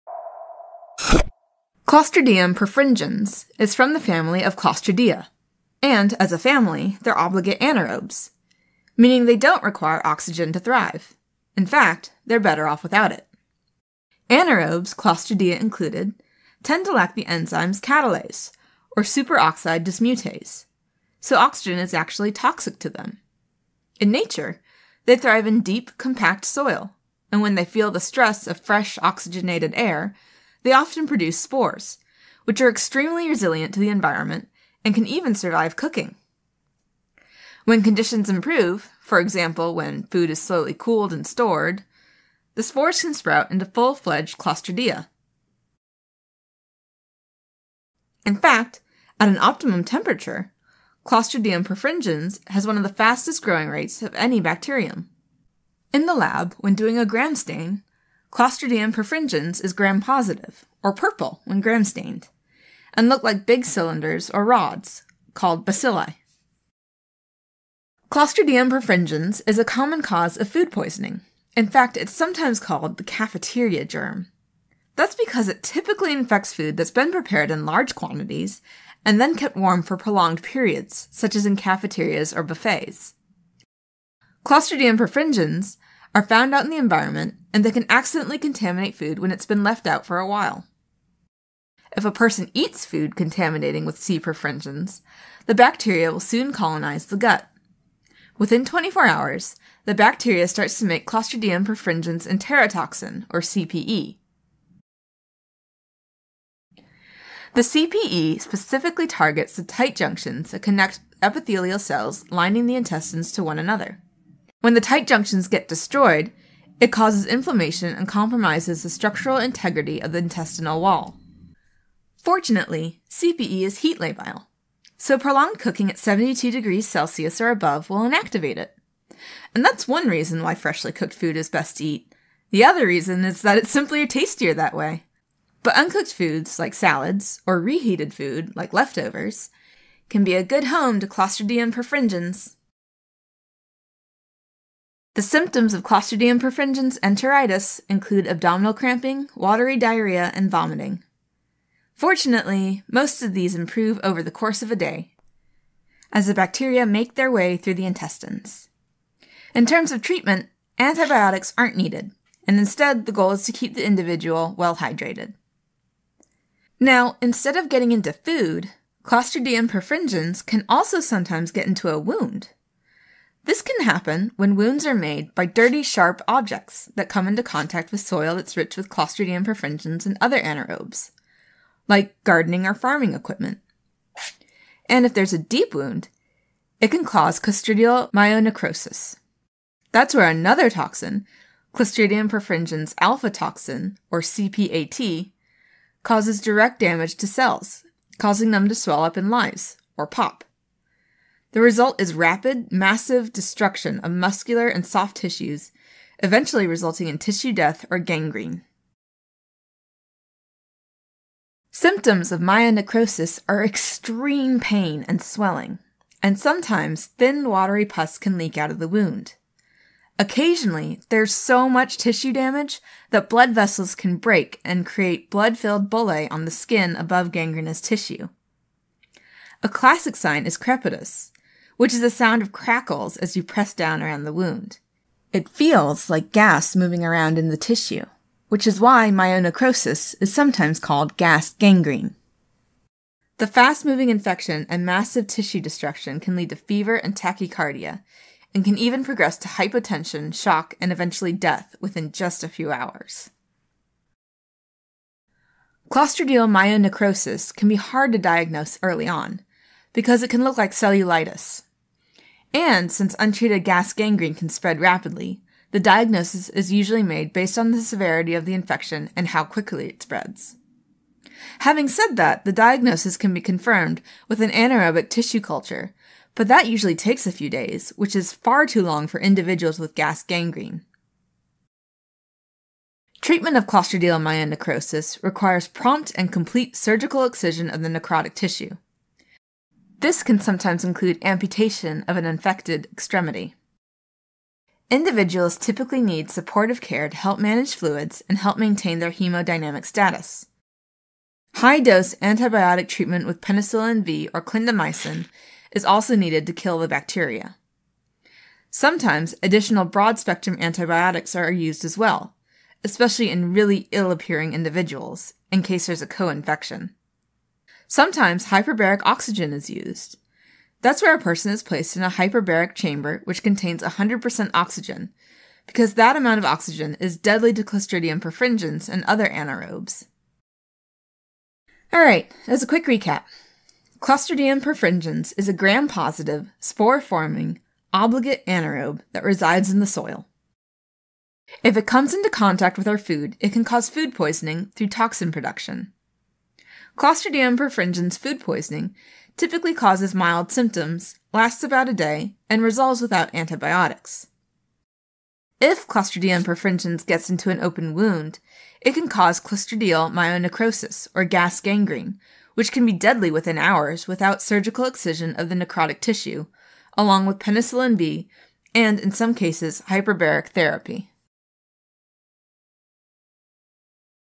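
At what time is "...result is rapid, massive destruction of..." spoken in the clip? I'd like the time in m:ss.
3:21.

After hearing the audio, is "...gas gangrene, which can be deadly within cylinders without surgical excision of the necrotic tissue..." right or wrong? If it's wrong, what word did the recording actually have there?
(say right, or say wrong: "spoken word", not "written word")
wrong: "hours", not "cylinders".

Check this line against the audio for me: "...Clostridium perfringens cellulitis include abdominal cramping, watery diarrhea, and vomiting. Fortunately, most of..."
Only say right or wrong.
wrong.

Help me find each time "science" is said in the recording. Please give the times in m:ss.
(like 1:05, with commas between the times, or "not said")
not said.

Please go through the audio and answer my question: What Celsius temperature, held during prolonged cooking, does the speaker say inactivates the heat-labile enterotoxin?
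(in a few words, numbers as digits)
72 degrees Celsius.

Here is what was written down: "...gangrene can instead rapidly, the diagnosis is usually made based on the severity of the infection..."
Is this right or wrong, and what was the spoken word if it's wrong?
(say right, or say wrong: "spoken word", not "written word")
wrong: "spread", not "instead".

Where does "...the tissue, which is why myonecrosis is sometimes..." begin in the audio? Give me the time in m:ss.
3:57.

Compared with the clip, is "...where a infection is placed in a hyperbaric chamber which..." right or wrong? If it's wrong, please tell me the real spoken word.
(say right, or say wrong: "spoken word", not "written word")
wrong: "person", not "infection".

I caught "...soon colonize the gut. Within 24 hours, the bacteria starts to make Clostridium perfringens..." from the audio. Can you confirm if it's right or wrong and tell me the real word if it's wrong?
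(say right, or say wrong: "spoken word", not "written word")
right.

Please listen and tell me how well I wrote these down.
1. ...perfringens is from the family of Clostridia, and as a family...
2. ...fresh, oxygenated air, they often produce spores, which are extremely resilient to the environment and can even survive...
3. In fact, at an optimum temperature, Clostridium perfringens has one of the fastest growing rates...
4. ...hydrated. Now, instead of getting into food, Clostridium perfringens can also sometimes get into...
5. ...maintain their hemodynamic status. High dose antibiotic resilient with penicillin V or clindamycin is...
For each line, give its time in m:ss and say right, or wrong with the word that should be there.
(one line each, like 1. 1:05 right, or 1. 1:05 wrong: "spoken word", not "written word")
1. 0:02 right
2. 0:28 right
3. 0:48 right
4. 2:44 right
5. 4:58 wrong: "treatment", not "resilient".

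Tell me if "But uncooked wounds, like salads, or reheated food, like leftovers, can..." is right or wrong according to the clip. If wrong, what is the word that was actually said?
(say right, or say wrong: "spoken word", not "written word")
wrong: "foods", not "wounds".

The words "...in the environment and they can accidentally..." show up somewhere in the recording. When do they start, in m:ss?
1:26.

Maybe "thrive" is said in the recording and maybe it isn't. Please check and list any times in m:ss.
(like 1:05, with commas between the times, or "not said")
0:10, 0:25.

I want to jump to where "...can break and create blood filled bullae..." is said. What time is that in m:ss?
3:43.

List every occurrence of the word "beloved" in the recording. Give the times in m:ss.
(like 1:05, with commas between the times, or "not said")
not said.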